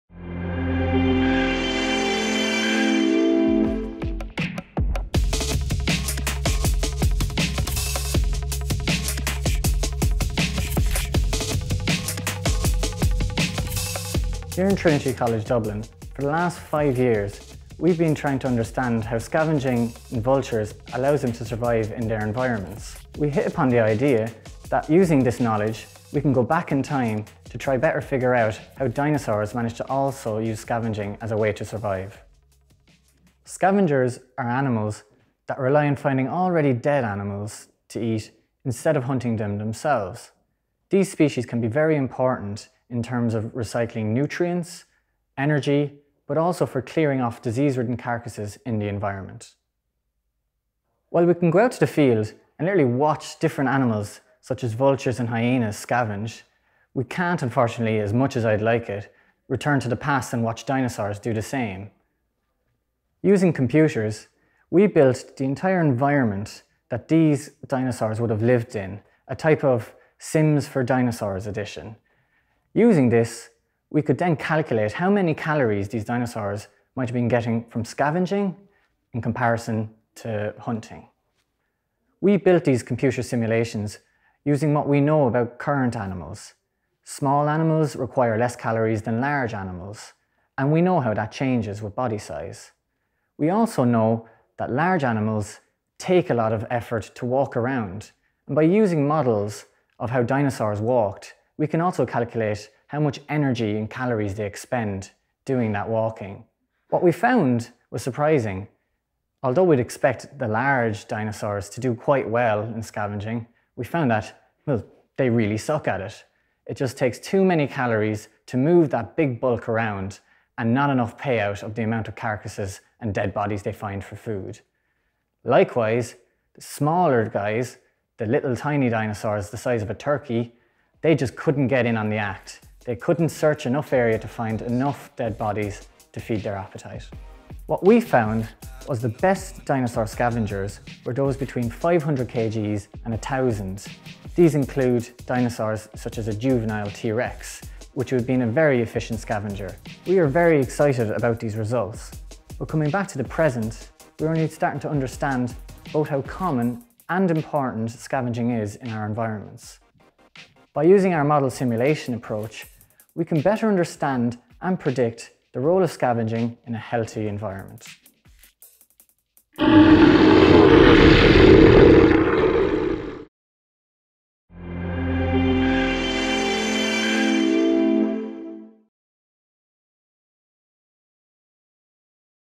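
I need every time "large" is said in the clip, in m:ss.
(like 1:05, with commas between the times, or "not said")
1:29, 1:34, 1:50.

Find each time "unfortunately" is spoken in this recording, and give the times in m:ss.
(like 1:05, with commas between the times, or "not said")
0:57.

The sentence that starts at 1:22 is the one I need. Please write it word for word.
We built these computer simulations using what we know about current animals.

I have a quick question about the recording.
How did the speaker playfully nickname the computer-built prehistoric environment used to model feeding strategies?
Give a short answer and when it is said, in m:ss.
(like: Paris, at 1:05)
Sims for Dinosaurs edition, at 1:10.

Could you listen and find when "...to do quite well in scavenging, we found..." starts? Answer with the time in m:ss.
1:51.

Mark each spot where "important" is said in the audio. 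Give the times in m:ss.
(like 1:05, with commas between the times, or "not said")
0:41, 2:37.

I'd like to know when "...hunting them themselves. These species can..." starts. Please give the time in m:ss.
0:39.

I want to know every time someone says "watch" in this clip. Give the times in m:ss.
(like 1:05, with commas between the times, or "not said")
0:52, 1:00.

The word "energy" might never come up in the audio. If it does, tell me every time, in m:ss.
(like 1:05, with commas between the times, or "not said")
0:45, 1:43.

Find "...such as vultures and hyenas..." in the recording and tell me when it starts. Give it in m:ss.
0:54.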